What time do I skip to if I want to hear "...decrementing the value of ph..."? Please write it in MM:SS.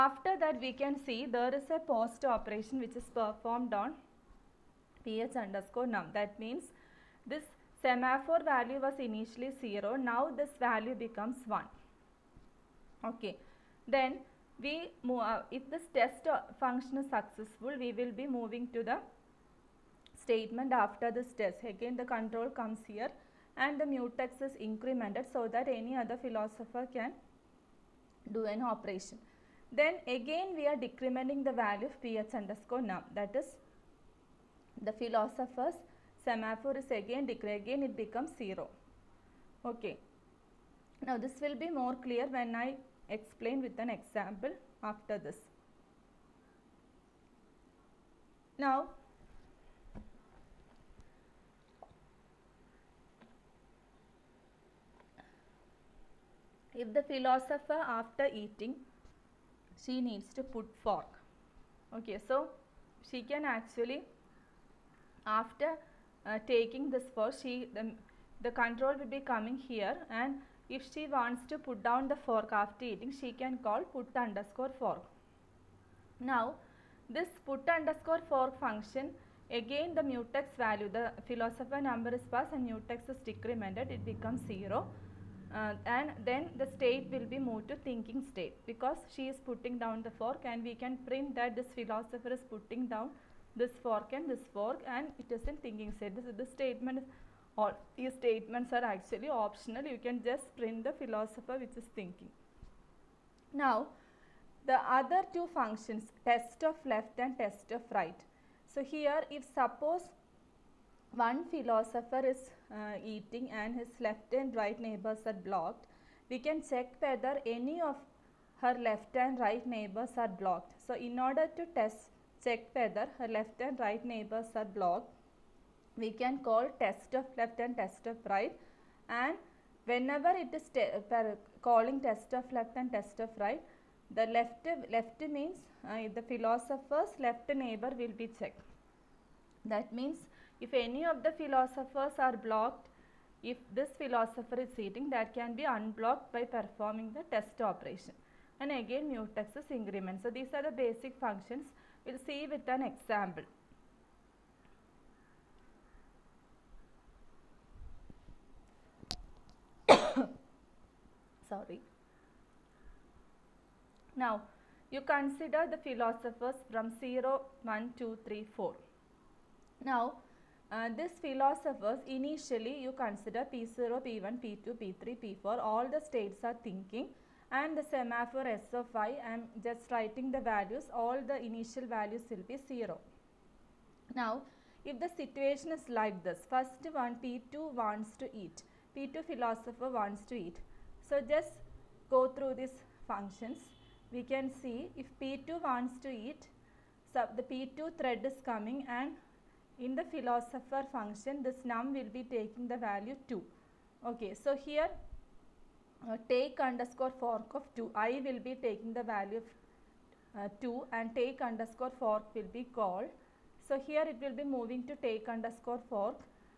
00:30.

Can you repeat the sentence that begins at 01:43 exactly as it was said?
Now the other two functions test of left and test of right.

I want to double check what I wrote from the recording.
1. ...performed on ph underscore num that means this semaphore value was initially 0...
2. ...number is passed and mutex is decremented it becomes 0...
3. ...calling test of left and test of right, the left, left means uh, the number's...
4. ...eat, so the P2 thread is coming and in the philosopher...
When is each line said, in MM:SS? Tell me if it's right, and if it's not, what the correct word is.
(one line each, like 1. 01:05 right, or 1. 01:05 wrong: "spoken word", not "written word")
1. 00:03 right
2. 01:21 right
3. 02:11 wrong: "philosopher", not "number"
4. 03:16 right.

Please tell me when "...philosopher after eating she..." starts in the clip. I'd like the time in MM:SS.
00:57.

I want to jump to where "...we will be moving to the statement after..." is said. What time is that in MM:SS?
00:17.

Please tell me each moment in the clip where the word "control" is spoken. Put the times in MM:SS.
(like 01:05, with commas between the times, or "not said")
00:22, 01:08.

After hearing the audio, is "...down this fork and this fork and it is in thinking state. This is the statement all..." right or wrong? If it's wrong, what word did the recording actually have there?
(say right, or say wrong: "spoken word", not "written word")
right.